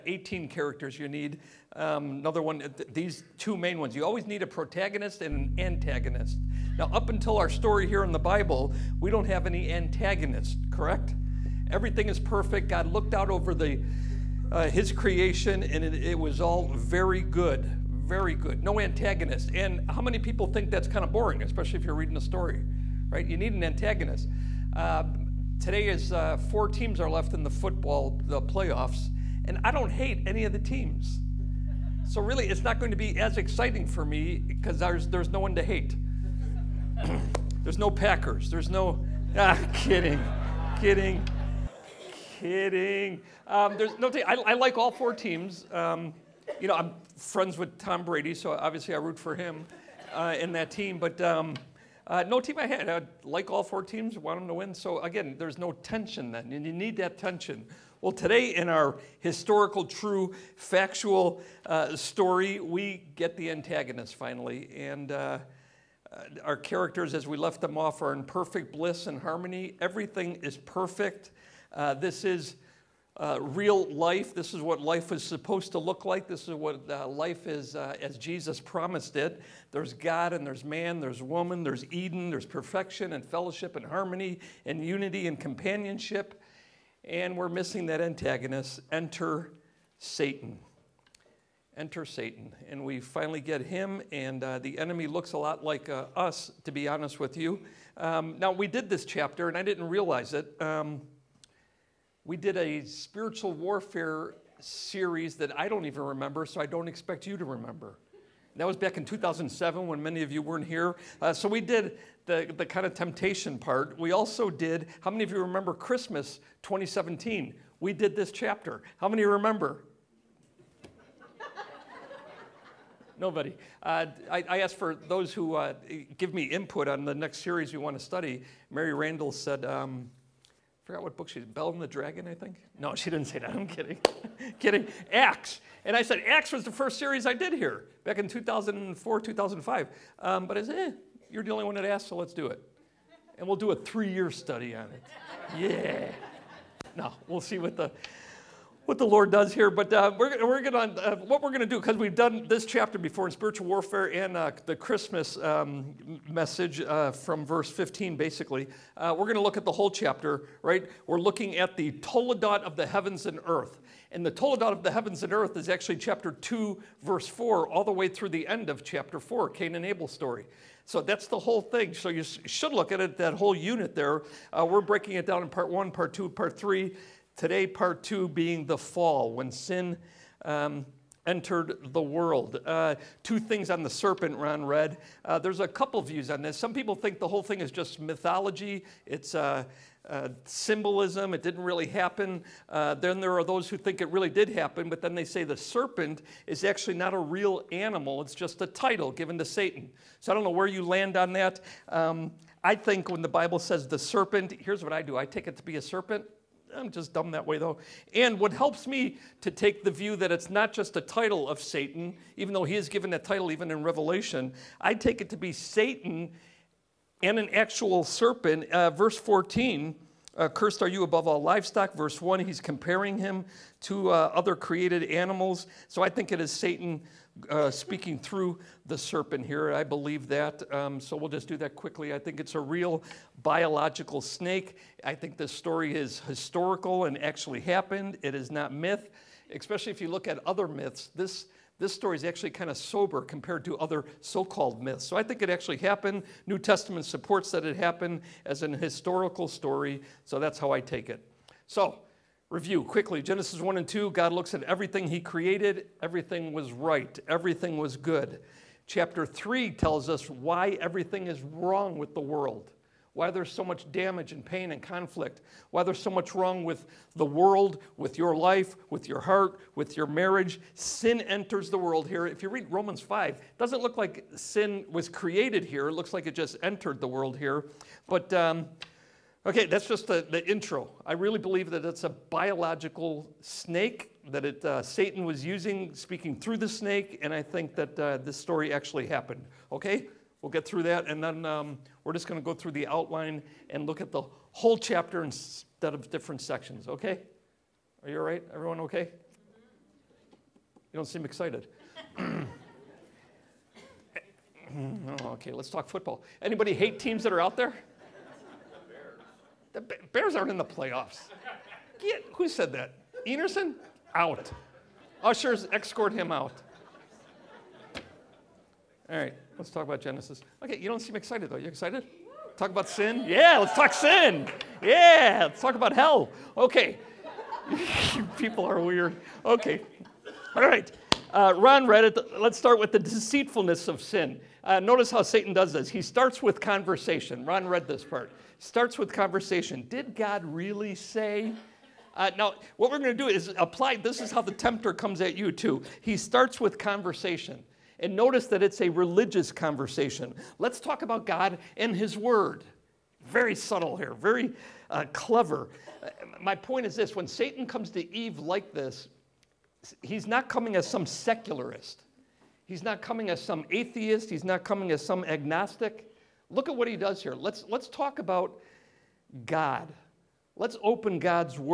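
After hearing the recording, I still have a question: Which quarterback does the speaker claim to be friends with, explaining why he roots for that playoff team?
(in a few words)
Tom Brady.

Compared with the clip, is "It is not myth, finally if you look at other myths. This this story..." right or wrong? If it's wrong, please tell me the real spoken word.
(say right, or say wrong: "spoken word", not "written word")
wrong: "especially", not "finally".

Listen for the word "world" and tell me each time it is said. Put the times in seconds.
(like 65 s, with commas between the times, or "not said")
182 s, 262 s, 267 s, 271 s, 277 s.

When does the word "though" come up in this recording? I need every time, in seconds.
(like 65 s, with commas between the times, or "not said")
207 s, 212 s, 321 s.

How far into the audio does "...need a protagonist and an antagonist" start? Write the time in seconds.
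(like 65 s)
4 s.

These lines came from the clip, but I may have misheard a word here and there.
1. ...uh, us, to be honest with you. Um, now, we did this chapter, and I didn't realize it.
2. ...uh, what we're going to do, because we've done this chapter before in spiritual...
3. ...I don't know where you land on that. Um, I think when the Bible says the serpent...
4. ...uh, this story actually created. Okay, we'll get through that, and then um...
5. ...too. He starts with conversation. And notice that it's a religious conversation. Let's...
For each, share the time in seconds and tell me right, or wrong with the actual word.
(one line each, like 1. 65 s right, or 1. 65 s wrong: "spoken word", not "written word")
1. 95 s right
2. 151 s right
3. 200 s right
4. 287 s wrong: "happened", not "created"
5. 345 s right.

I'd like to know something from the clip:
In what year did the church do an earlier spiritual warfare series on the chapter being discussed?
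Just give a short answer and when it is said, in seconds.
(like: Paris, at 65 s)
2007, at 109 s.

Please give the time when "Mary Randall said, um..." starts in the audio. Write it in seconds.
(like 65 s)
128 s.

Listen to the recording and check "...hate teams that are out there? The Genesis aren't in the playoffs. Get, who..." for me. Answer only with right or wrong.
wrong.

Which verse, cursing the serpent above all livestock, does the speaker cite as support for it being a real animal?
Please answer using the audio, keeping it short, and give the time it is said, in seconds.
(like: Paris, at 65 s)
Verse 14, at 218 s.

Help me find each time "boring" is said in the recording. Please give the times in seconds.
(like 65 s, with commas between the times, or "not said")
21 s.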